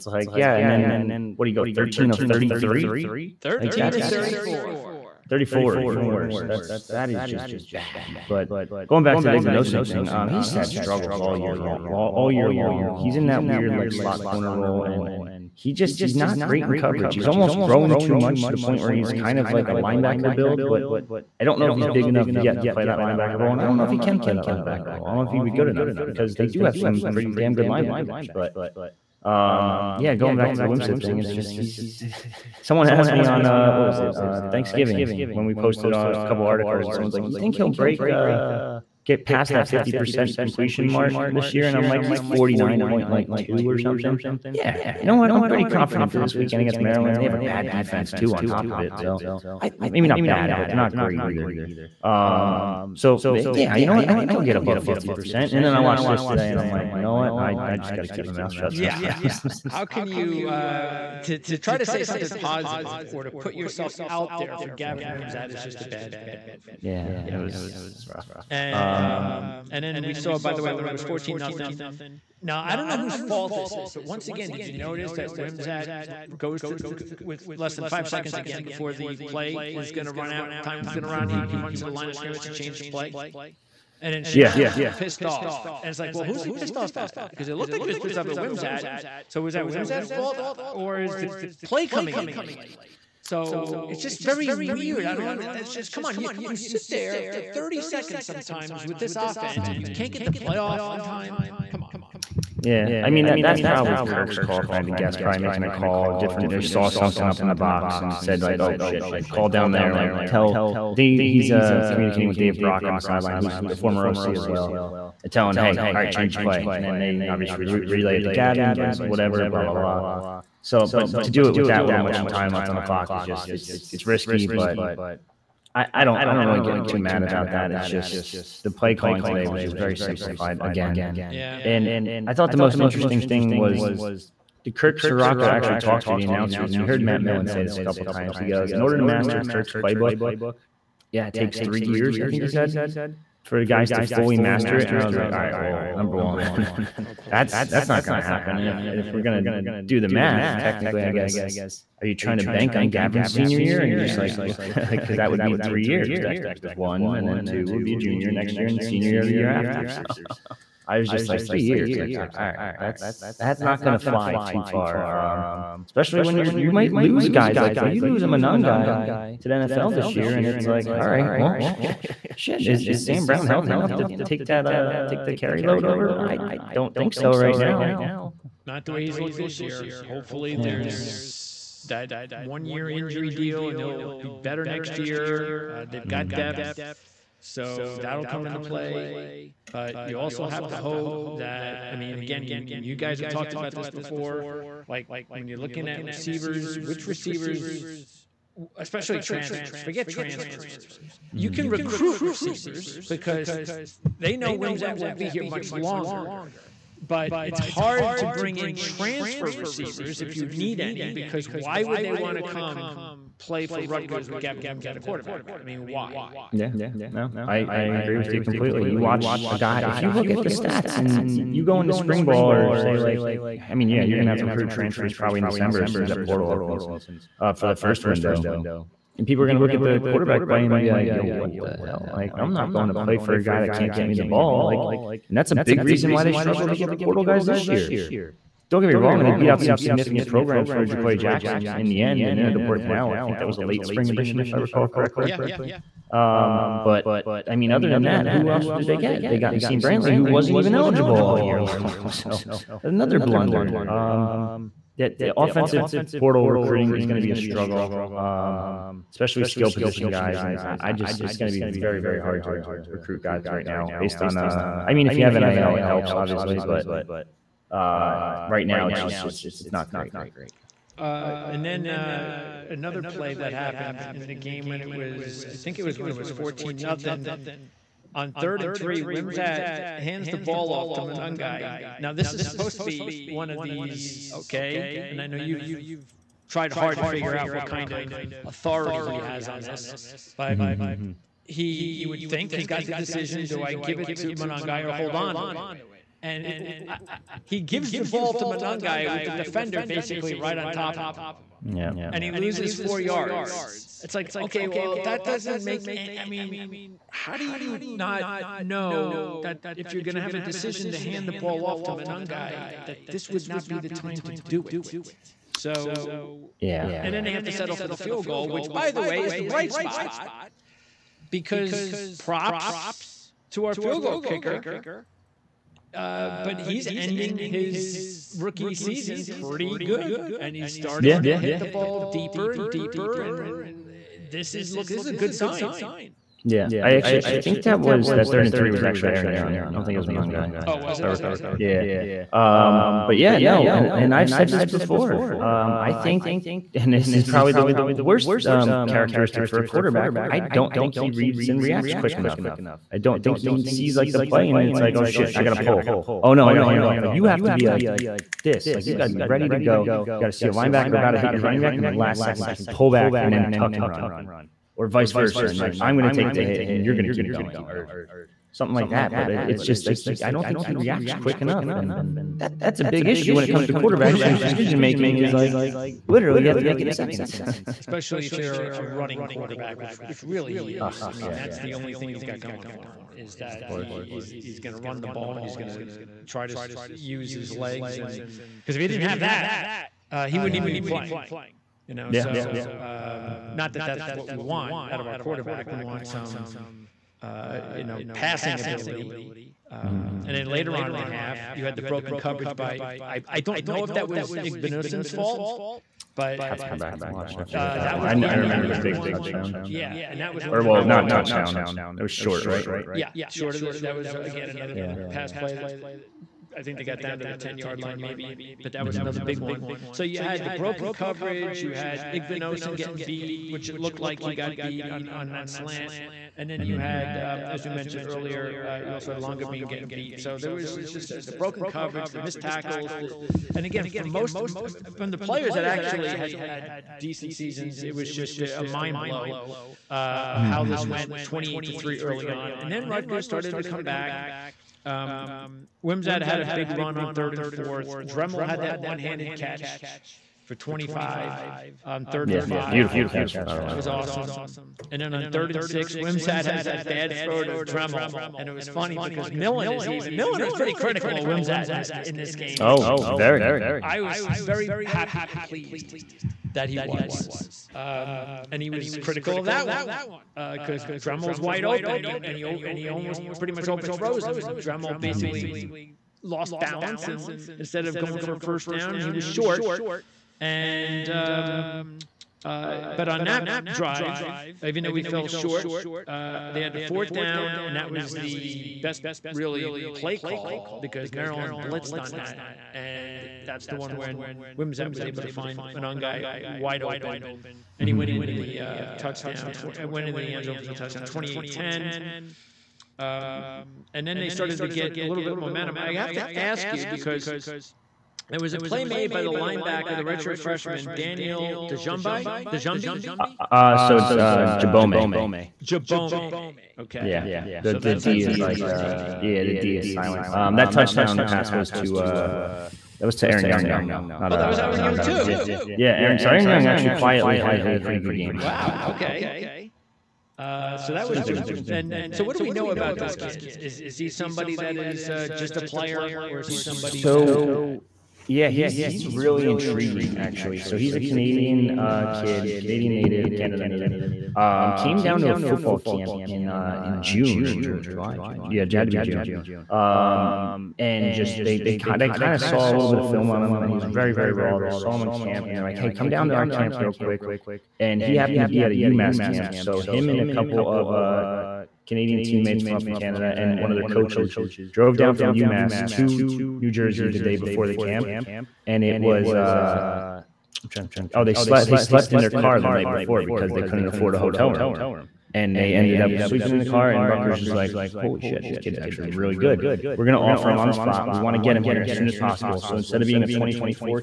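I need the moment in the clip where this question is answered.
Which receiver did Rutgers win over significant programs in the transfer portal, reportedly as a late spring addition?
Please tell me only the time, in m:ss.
4:00.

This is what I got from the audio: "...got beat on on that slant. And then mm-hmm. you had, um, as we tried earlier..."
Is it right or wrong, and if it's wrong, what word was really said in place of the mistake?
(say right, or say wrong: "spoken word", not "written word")
wrong: "mentioned", not "tried".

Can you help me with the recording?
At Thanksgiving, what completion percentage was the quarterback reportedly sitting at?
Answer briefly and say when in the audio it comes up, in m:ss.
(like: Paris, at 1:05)
49.2, at 0:42.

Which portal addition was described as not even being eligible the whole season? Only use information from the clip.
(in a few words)
Naseim Brantley.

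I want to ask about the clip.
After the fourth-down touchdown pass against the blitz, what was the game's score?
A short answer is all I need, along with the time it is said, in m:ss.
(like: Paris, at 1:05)
28-10, at 8:21.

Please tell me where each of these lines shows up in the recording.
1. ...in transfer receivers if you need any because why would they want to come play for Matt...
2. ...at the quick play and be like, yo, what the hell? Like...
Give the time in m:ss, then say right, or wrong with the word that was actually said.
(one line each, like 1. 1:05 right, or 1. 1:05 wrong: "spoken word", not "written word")
1. 3:28 wrong: "Rutgers", not "Matt"
2. 3:49 wrong: "quarterback", not "quick".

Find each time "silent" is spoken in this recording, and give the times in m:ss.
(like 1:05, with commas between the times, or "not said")
8:39.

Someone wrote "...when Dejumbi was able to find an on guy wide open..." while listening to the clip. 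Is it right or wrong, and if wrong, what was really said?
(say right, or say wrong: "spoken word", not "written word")
wrong: "Wimsatt", not "Dejumbi".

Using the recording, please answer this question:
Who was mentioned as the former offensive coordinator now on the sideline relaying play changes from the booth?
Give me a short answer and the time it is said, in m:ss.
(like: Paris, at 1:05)
Dave Brock, at 1:52.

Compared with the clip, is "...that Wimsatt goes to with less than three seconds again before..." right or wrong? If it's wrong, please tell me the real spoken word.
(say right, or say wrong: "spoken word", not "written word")
wrong: "five", not "three".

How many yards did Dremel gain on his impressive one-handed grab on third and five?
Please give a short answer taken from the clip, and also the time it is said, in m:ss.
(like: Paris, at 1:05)
25, at 7:30.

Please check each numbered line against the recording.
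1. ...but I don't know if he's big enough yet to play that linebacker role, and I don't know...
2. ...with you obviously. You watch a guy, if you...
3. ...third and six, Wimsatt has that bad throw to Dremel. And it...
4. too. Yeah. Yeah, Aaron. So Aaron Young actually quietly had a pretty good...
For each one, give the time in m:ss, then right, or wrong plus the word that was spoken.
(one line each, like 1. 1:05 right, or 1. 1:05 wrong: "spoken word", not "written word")
1. 0:20 right
2. 3:38 wrong: "completely", not "obviously"
3. 7:35 right
4. 8:45 right.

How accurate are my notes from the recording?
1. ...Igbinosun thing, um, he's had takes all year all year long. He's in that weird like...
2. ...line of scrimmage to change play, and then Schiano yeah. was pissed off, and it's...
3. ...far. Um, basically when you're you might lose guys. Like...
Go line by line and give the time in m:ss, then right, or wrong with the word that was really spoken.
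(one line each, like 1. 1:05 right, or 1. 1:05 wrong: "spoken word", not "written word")
1. 0:09 wrong: "struggles", not "takes"
2. 1:21 right
3. 2:44 wrong: "especially", not "basically".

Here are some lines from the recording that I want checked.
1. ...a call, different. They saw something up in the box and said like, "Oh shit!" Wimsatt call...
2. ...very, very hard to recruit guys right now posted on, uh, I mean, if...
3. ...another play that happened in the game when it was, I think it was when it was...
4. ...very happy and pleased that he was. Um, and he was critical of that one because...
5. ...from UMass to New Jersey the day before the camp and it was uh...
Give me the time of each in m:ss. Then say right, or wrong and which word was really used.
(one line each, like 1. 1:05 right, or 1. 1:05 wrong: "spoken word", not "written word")
1. 1:45 wrong: "Like", not "Wimsatt"
2. 4:21 wrong: "based", not "posted"
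3. 4:32 right
4. 7:44 right
5. 9:25 right.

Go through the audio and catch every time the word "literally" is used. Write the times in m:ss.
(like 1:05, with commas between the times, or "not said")
6:16.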